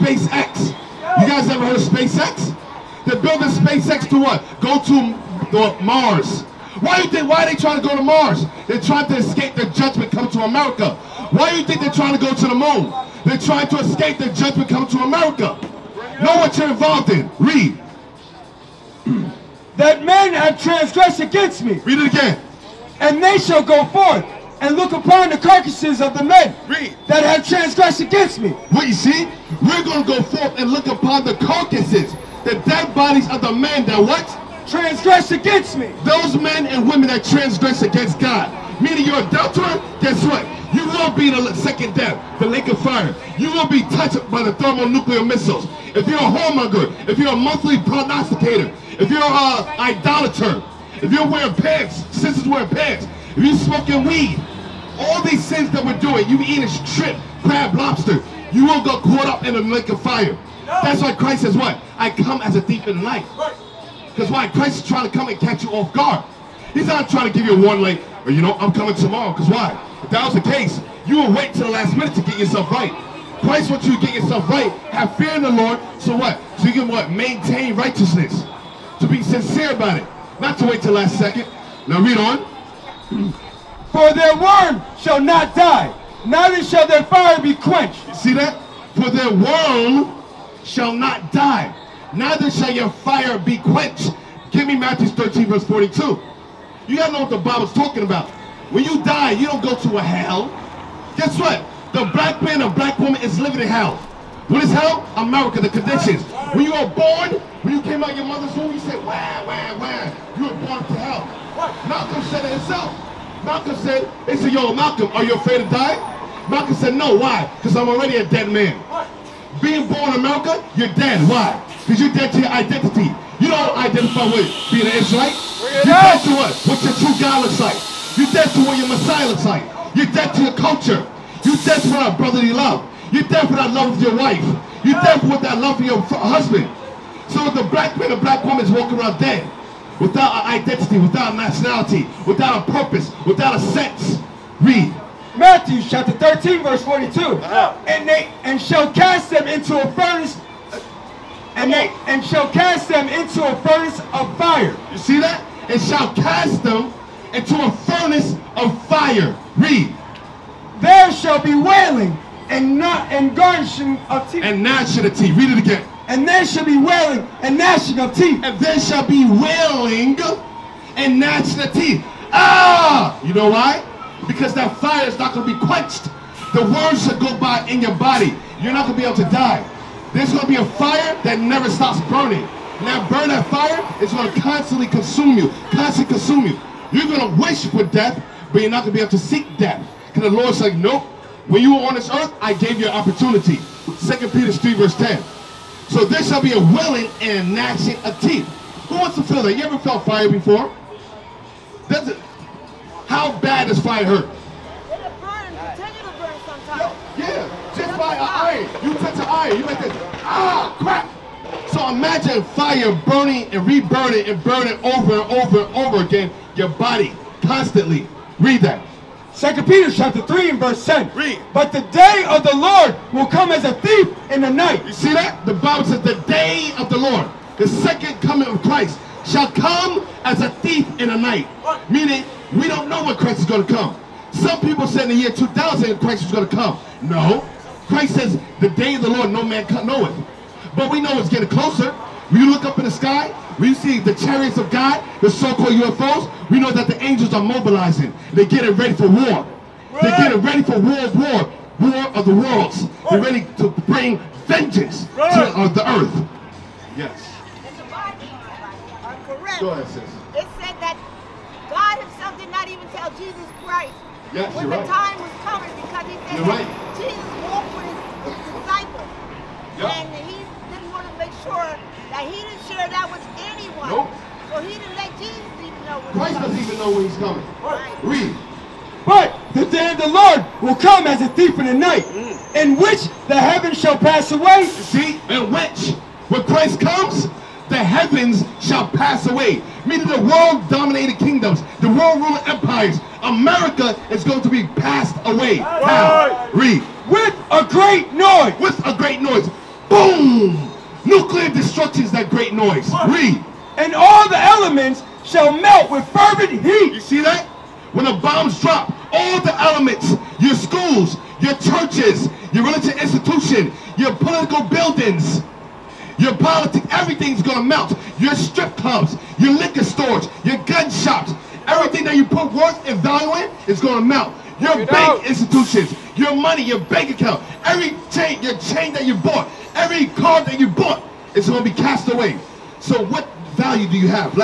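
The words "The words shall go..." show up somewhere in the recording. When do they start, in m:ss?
2:56.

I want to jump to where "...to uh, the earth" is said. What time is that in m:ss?
4:15.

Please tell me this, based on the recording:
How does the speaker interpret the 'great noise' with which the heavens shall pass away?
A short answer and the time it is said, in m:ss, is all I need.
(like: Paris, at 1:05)
Nuclear destruction, at 5:01.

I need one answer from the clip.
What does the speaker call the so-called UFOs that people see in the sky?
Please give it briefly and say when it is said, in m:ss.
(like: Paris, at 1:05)
Chariots of God, at 4:04.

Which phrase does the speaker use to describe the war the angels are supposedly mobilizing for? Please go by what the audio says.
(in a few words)
War of the worlds.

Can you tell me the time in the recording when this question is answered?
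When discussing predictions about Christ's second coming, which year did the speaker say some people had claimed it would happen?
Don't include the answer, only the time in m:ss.
3:55.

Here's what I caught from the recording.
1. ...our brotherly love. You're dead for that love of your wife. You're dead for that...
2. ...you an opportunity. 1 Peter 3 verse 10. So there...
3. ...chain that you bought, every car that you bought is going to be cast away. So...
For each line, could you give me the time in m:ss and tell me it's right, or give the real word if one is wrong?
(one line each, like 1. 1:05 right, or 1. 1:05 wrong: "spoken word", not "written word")
1. 2:11 right
2. 3:12 wrong: "2", not "1"
3. 5:28 right.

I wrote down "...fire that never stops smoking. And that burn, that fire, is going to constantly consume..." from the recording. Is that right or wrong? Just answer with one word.
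wrong.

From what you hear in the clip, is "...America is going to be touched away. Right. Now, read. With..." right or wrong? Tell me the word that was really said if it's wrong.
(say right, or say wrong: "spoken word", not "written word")
wrong: "passed", not "touched".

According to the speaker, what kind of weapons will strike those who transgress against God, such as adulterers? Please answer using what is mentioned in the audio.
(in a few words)
Thermonuclear missiles.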